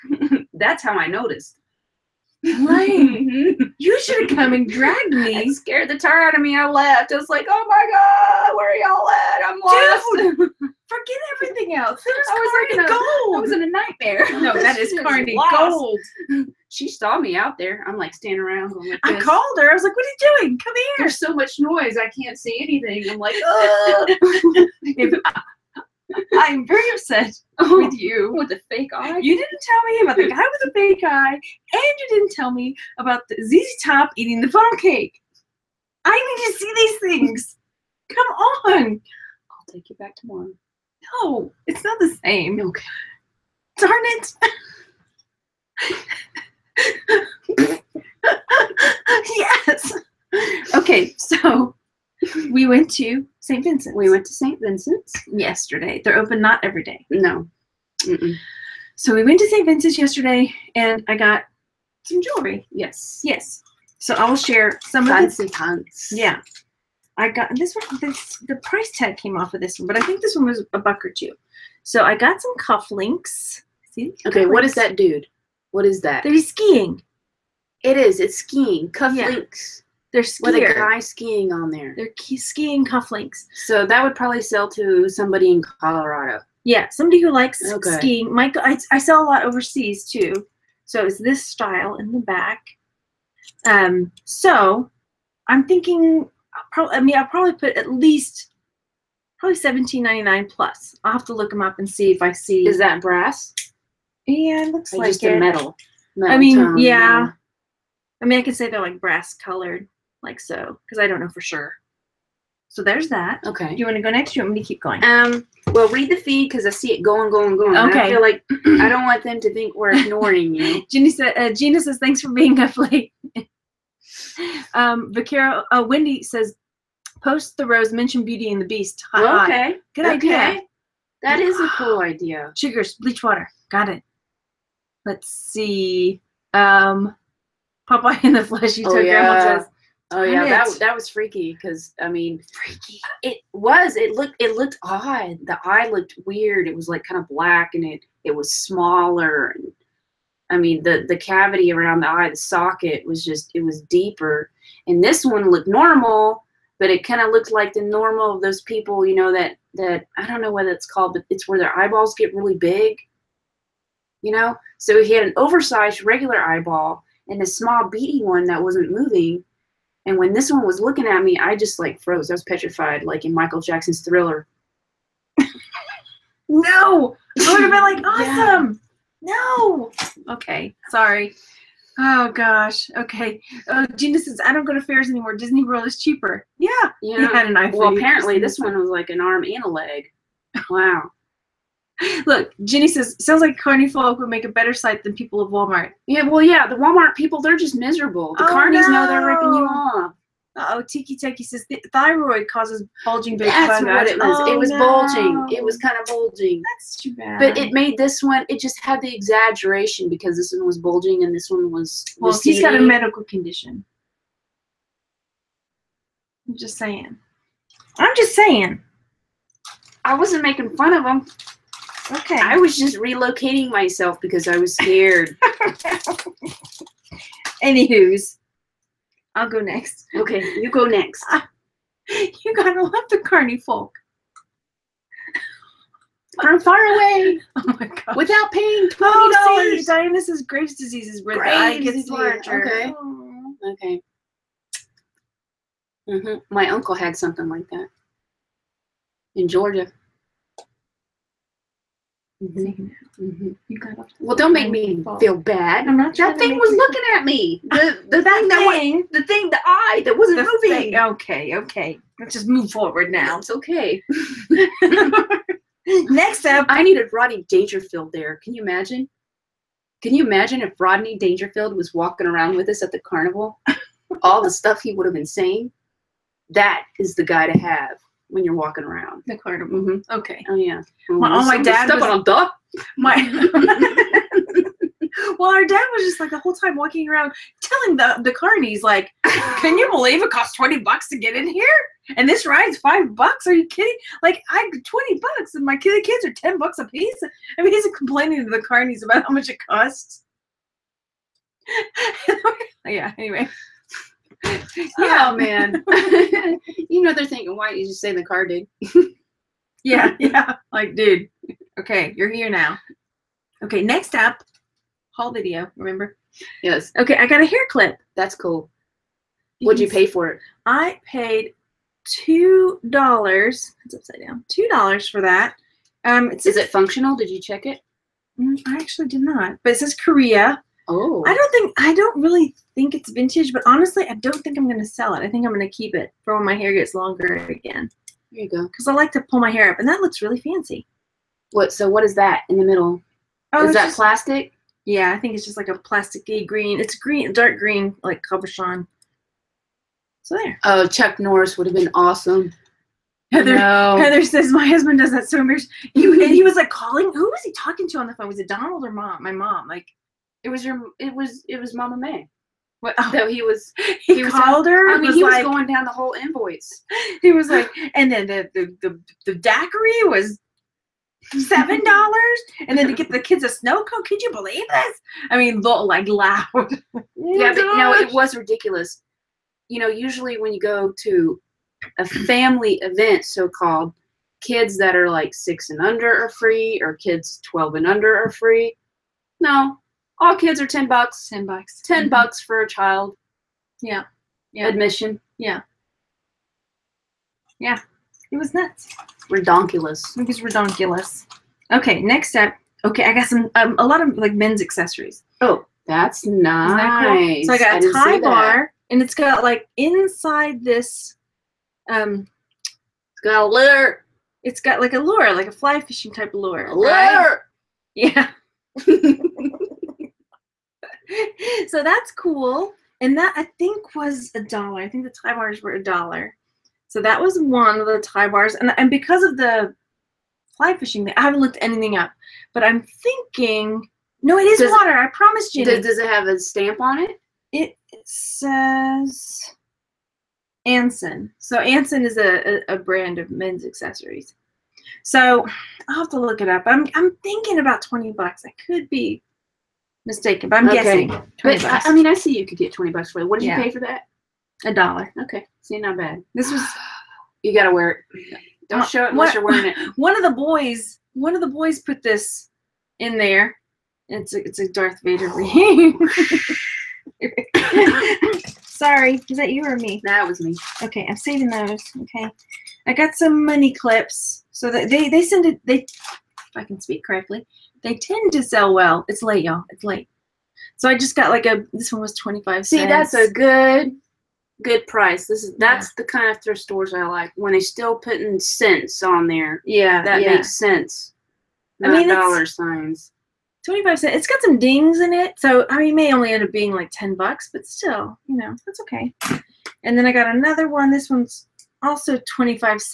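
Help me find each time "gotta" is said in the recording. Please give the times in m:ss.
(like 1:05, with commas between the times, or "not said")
3:52, 7:37.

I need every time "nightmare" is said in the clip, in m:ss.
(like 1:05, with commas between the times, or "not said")
0:13.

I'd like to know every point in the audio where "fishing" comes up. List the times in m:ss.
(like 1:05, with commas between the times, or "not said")
6:55, 7:10.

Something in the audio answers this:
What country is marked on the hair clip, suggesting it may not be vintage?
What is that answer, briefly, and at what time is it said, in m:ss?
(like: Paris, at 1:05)
Korea, at 5:29.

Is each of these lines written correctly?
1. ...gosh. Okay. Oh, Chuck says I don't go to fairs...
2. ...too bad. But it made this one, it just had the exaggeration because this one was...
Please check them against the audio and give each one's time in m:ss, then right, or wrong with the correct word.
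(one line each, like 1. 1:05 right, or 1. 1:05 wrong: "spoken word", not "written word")
1. 3:02 wrong: "Gina", not "Chuck"
2. 3:26 right.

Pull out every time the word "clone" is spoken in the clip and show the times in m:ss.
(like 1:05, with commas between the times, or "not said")
not said.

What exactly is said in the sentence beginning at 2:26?
It was like kind of black, and it it was smaller.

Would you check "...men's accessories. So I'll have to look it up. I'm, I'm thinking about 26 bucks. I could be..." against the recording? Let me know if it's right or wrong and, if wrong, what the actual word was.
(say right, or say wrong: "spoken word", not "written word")
wrong: "20", not "26".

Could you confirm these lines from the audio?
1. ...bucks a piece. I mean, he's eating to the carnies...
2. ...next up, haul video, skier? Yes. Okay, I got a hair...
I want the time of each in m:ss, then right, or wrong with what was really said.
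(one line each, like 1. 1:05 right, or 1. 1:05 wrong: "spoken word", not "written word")
1. 4:56 wrong: "complaining", not "eating"
2. 5:13 wrong: "remember", not "skier".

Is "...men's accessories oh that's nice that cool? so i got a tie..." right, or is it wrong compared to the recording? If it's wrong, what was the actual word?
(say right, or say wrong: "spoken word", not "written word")
right.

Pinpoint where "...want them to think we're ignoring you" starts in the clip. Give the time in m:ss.
1:59.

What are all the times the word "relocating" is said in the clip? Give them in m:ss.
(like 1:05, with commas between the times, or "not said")
3:42.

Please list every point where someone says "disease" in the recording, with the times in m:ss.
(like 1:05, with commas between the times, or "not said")
4:00.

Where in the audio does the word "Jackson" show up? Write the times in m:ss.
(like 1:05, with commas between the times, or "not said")
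2:53.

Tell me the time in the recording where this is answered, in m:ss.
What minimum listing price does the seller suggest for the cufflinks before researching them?
1:39.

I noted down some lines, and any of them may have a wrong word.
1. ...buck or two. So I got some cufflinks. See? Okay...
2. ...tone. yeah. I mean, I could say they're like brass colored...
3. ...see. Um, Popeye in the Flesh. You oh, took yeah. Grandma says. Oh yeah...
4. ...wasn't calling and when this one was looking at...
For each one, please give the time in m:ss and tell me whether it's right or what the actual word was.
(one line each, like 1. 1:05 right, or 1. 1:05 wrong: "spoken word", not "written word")
1. 1:10 right
2. 1:46 right
3. 2:15 right
4. 2:48 wrong: "moving", not "calling".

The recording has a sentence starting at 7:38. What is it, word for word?
Don't uh, show it unless what, you're wearing it.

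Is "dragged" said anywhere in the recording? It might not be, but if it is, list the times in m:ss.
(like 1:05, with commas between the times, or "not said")
0:04.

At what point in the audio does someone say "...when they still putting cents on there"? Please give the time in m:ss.
8:07.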